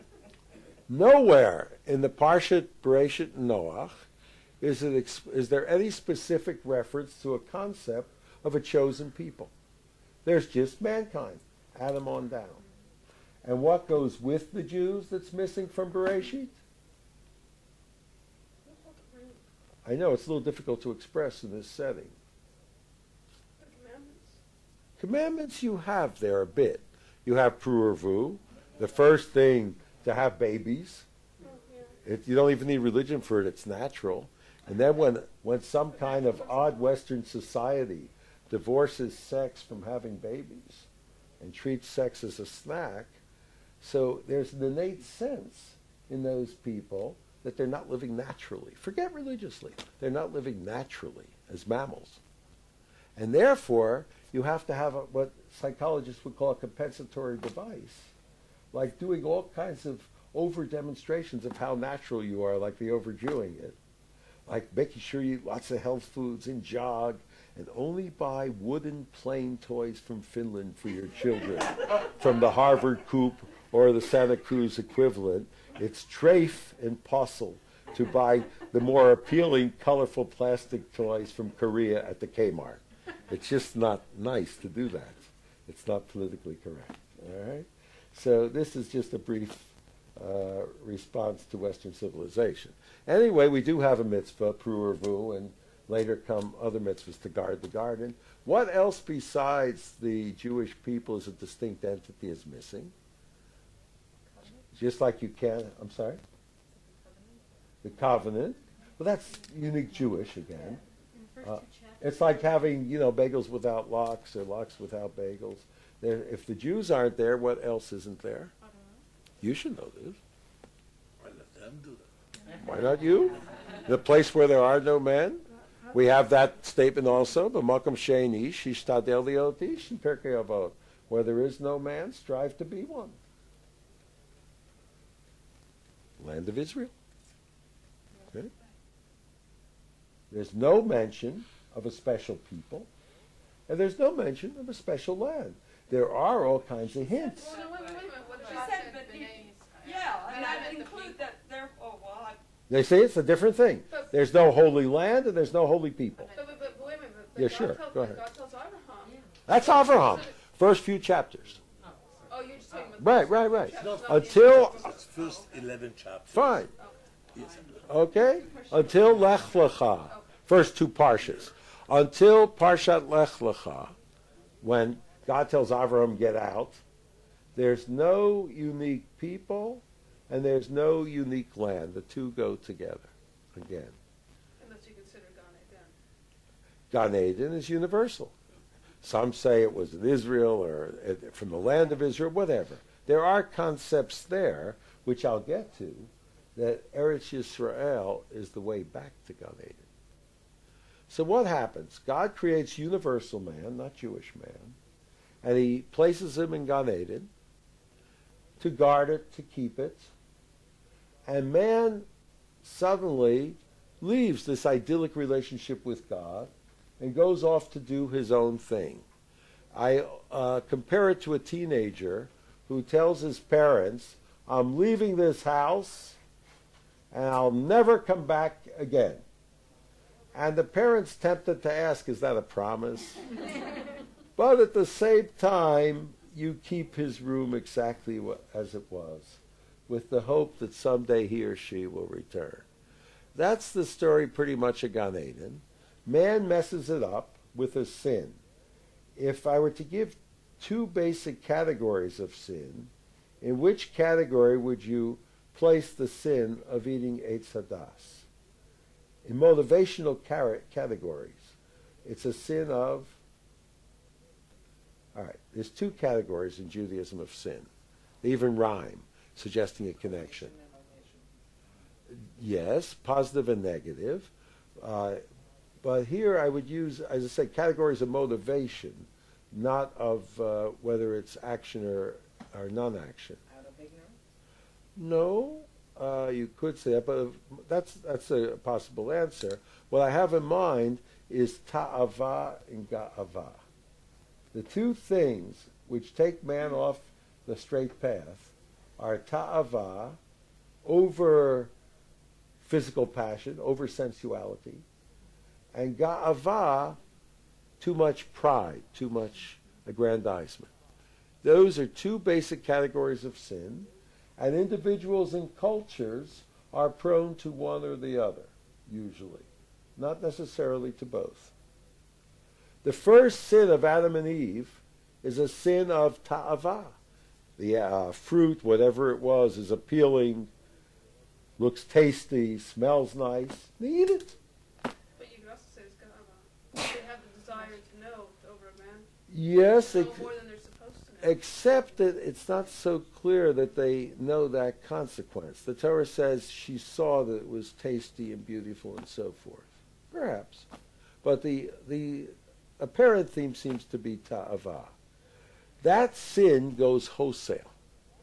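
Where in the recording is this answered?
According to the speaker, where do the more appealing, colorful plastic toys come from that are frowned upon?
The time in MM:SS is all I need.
01:21.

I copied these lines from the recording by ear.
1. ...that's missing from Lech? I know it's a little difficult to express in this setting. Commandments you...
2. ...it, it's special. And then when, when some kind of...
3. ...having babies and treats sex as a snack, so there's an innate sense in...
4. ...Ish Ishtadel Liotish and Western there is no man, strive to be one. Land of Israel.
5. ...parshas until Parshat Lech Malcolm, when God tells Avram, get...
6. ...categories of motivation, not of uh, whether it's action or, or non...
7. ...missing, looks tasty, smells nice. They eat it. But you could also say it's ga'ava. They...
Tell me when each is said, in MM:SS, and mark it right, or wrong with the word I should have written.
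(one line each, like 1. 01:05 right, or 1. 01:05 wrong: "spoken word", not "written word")
1. 00:15 wrong: "Bereshit", not "Lech"
2. 00:33 wrong: "natural", not "special"
3. 00:39 right
4. 02:08 wrong: "Where", not "Western"
5. 02:50 wrong: "Lecha", not "Malcolm"
6. 04:37 right
7. 05:29 wrong: "appealing", not "missing".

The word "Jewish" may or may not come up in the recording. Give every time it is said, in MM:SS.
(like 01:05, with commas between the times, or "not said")
01:40, 01:49, 03:23.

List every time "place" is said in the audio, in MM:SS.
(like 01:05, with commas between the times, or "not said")
02:03, 03:25, 04:15.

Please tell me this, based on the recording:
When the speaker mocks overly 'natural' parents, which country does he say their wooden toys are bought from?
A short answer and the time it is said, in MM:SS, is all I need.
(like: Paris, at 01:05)
Finland, at 01:10.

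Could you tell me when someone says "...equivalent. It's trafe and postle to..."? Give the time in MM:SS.
01:14.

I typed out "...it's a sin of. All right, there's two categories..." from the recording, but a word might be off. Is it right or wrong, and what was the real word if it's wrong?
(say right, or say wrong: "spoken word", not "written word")
right.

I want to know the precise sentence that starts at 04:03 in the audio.
That's the story pretty much of Gan Eden.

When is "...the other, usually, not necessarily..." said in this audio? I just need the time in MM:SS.
05:17.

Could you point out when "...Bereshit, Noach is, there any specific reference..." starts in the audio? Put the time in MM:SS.
00:02.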